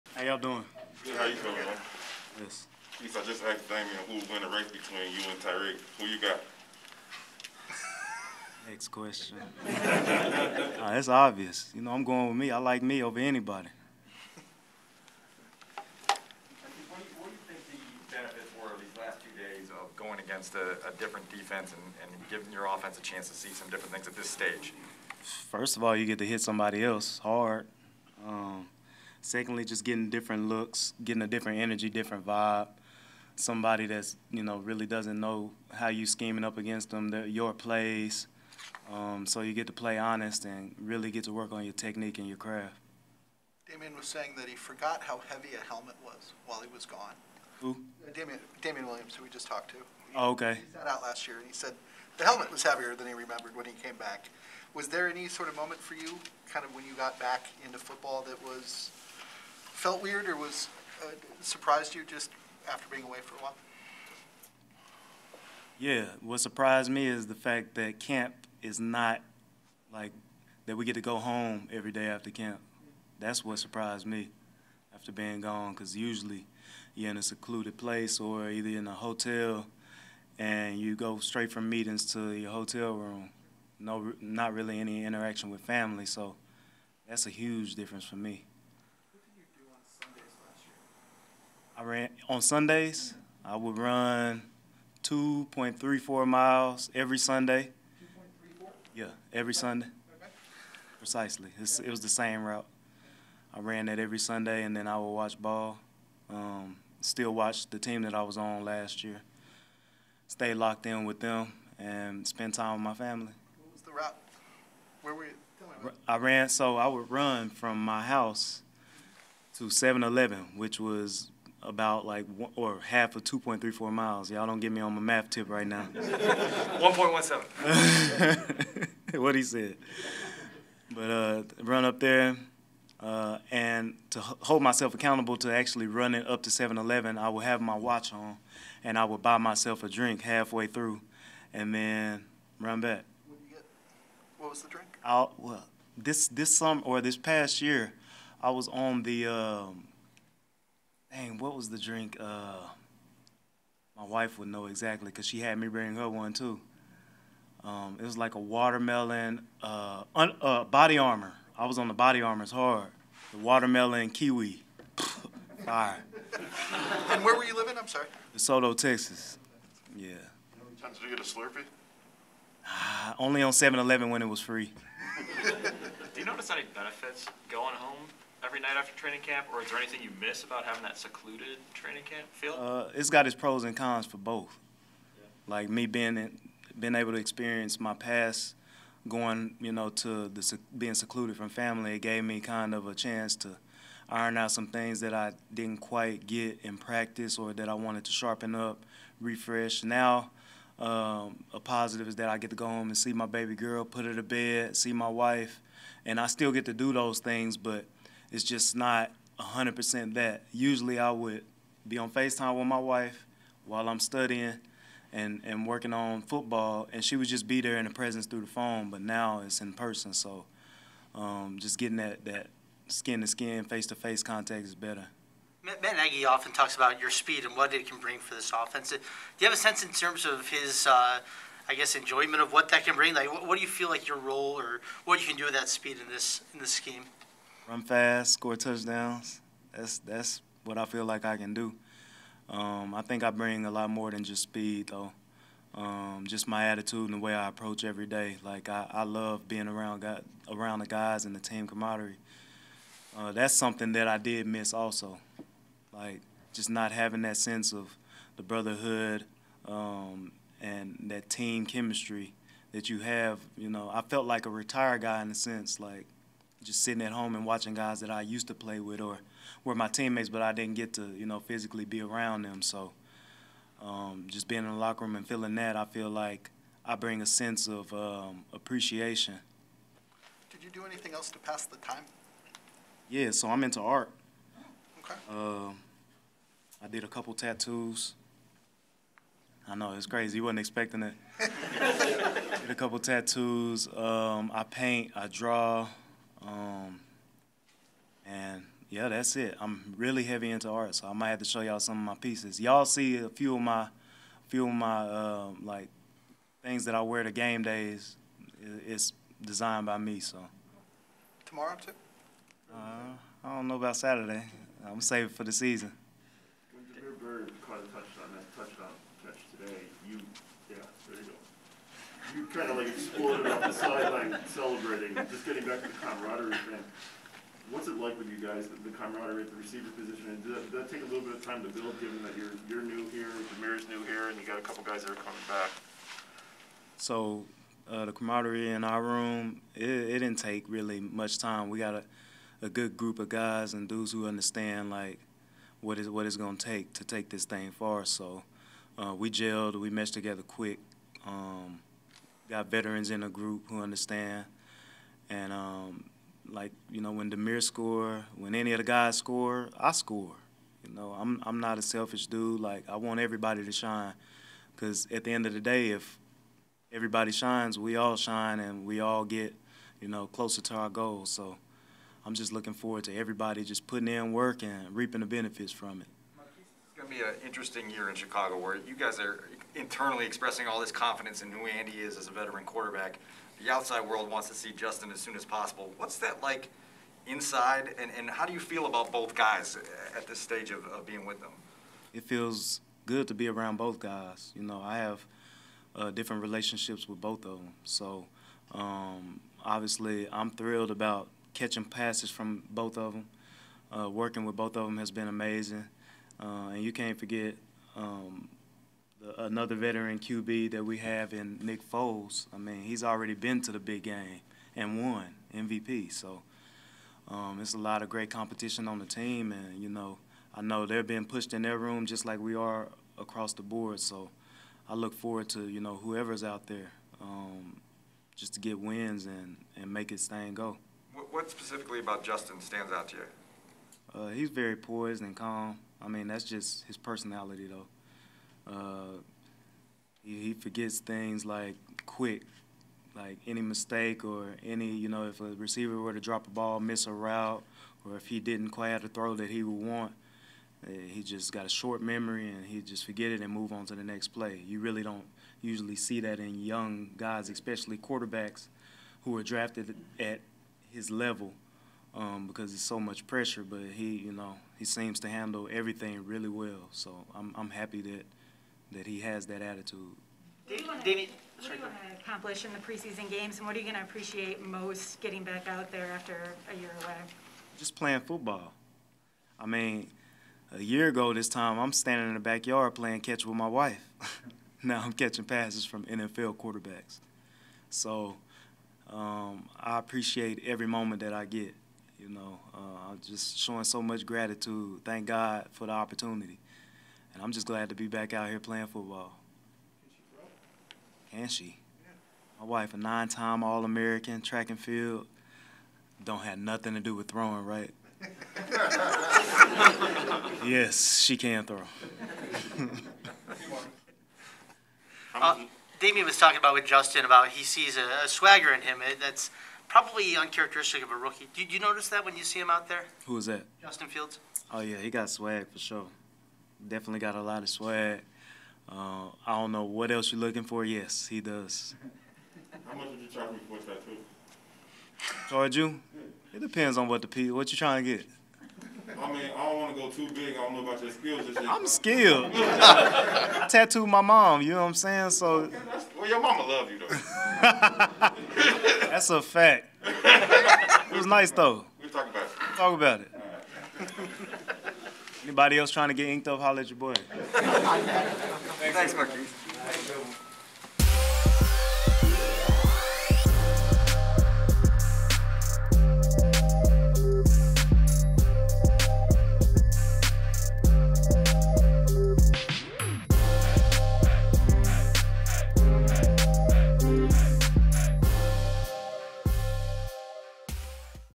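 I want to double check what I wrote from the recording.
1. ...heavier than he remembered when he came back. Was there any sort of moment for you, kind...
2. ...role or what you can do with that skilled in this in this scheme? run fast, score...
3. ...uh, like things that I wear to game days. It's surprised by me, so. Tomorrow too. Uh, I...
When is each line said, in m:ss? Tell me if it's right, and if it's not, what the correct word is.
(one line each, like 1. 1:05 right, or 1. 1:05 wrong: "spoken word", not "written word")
1. 0:52 right
2. 3:54 wrong: "speed", not "skilled"
3. 5:05 wrong: "designed", not "surprised".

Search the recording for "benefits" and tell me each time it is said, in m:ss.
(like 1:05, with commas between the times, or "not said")
2:56, 6:15.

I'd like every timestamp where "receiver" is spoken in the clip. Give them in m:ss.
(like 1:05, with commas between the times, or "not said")
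5:29, 7:25.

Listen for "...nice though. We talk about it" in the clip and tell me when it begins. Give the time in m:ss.
9:11.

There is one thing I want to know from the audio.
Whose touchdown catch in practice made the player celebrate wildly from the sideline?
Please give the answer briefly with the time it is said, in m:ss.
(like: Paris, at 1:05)
Damiere Byrd, at 5:16.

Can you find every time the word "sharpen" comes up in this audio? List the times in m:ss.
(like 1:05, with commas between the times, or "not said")
3:18.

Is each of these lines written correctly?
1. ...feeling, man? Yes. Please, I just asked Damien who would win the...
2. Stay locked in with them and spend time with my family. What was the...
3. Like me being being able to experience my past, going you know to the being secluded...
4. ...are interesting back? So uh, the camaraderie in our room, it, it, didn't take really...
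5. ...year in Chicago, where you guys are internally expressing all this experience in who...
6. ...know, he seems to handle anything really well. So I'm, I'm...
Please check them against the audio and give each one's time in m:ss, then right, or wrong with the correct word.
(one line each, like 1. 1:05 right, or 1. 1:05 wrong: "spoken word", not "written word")
1. 0:01 right
2. 1:50 right
3. 3:05 right
4. 5:35 wrong: "coming", not "interesting"
5. 6:17 wrong: "confidence", not "experience"
6. 7:44 wrong: "everything", not "anything".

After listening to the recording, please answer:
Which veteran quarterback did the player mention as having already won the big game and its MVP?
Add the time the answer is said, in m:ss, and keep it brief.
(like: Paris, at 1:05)
Nick Foles, at 6:51.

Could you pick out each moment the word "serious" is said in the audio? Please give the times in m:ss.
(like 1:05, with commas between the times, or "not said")
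not said.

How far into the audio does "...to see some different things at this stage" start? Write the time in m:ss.
0:23.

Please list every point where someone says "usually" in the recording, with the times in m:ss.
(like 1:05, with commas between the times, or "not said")
1:15, 3:30, 7:35.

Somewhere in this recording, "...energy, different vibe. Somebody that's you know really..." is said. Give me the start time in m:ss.
0:31.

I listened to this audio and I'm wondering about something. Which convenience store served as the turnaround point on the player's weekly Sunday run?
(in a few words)
7-Eleven.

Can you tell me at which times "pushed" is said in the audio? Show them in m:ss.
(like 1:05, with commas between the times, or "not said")
7:01.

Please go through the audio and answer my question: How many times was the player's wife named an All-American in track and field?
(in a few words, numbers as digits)
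9.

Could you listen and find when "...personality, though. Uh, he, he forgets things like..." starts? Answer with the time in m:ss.
7:16.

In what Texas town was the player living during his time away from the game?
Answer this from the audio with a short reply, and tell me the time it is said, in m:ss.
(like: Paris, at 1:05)
DeSoto, at 2:48.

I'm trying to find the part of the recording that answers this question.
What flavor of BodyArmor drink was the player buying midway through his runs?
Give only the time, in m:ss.
2:43.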